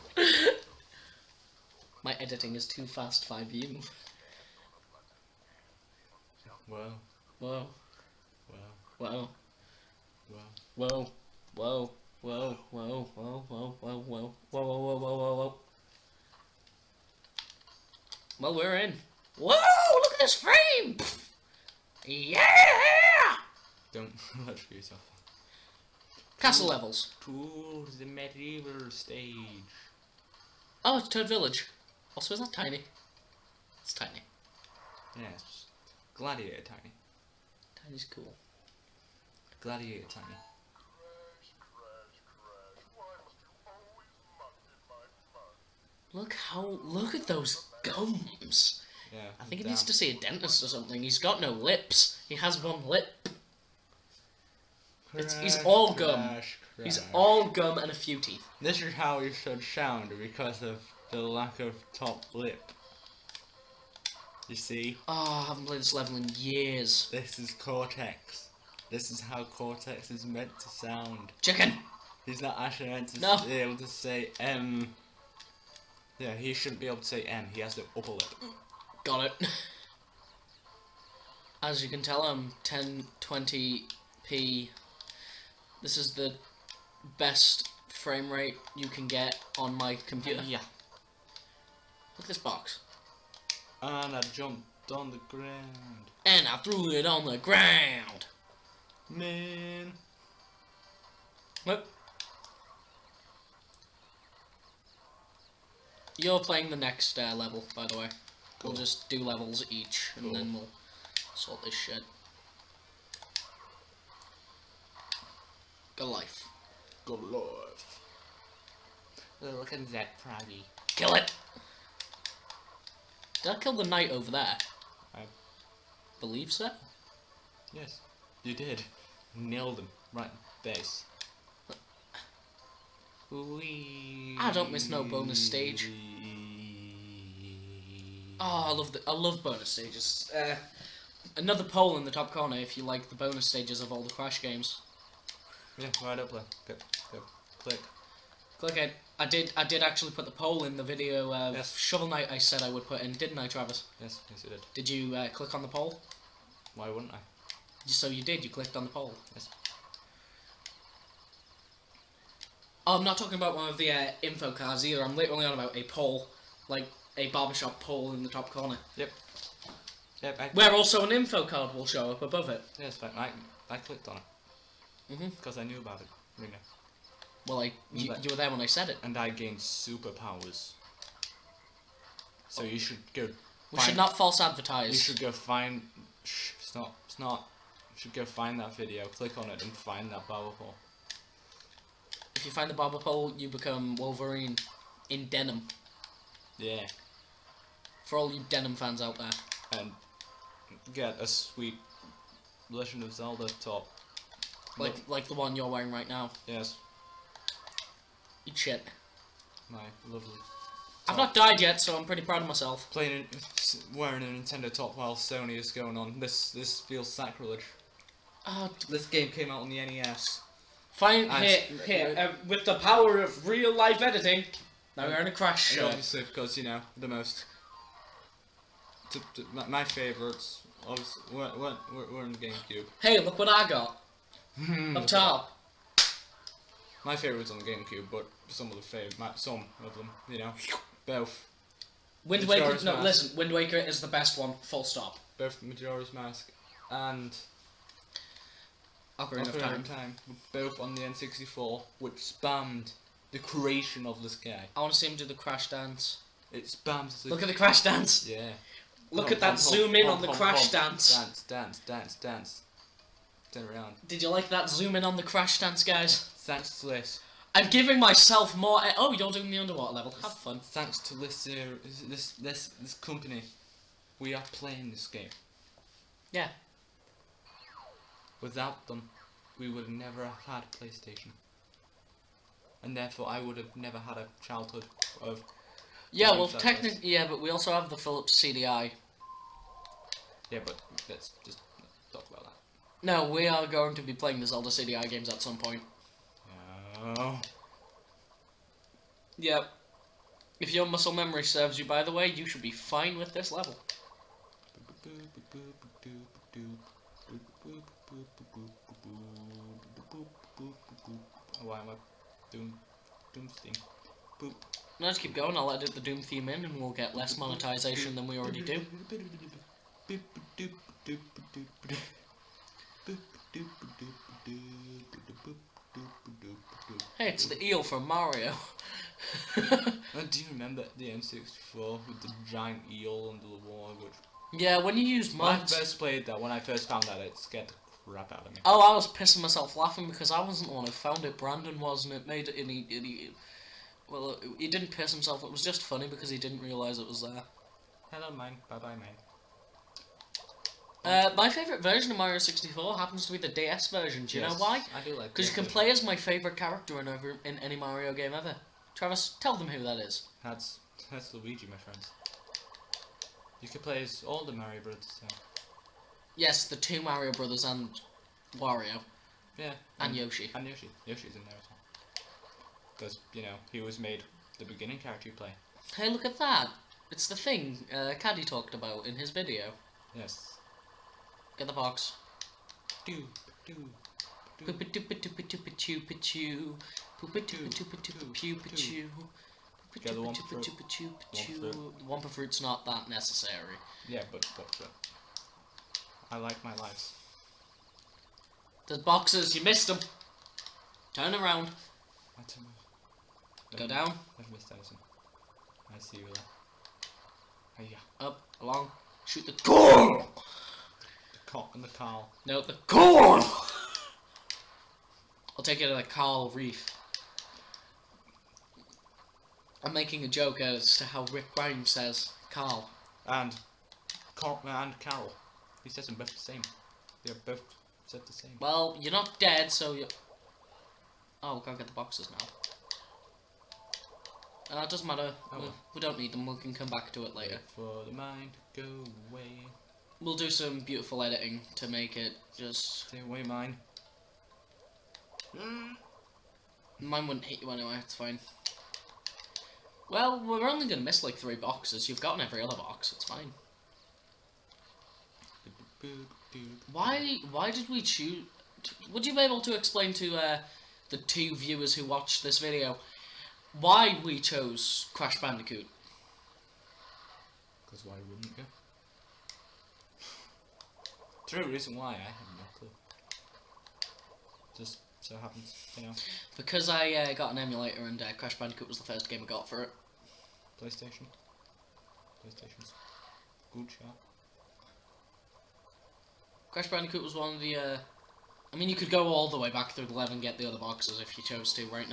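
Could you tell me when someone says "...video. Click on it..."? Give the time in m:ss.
3:08.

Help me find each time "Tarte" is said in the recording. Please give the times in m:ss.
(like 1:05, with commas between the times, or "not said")
not said.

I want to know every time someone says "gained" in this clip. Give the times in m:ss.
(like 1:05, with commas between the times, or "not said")
2:59.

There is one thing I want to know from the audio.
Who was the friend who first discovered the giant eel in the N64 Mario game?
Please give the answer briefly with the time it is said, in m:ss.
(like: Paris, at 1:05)
Brandon, at 5:41.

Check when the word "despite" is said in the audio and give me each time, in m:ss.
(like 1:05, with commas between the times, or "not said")
not said.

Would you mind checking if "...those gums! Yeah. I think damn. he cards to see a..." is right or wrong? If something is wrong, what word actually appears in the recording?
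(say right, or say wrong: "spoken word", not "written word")
wrong: "needs", not "cards".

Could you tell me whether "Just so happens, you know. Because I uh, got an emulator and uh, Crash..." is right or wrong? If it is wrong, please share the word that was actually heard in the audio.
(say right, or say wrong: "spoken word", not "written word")
right.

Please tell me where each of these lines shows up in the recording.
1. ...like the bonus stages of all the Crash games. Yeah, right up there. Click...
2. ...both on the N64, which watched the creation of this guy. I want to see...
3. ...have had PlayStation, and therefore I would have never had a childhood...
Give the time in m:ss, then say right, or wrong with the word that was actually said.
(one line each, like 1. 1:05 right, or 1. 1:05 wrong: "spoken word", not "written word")
1. 2:22 right
2. 4:10 wrong: "spammed", not "watched"
3. 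4:40 right.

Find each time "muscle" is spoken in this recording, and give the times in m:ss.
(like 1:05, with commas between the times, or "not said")
5:00.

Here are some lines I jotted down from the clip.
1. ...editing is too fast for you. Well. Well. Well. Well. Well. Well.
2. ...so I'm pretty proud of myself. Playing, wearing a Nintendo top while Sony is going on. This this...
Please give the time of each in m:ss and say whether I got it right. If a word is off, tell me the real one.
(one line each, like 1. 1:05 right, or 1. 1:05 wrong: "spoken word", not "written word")
1. 0:02 right
2. 3:31 right.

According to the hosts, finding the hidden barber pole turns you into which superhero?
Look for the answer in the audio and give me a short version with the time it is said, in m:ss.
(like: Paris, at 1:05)
Wolverine, at 3:13.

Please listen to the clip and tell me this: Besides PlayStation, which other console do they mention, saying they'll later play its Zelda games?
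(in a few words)
Philips CDI.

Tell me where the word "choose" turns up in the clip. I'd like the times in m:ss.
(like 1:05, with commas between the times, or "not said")
7:38.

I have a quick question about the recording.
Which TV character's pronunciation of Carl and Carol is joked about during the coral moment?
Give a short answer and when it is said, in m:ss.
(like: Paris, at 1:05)
Rick Grimes, at 7:01.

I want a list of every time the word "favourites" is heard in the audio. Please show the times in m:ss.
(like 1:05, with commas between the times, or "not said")
3:49, 3:57, 5:51, 5:56.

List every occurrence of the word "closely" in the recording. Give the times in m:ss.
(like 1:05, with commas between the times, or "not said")
not said.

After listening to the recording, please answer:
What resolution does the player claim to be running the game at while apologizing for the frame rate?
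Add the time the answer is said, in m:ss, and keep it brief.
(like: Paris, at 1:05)
1020p, at 1:22.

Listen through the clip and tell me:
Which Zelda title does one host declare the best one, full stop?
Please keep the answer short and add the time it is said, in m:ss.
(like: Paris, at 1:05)
Wind Waker, at 4:03.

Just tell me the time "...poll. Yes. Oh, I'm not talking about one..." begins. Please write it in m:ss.
2:38.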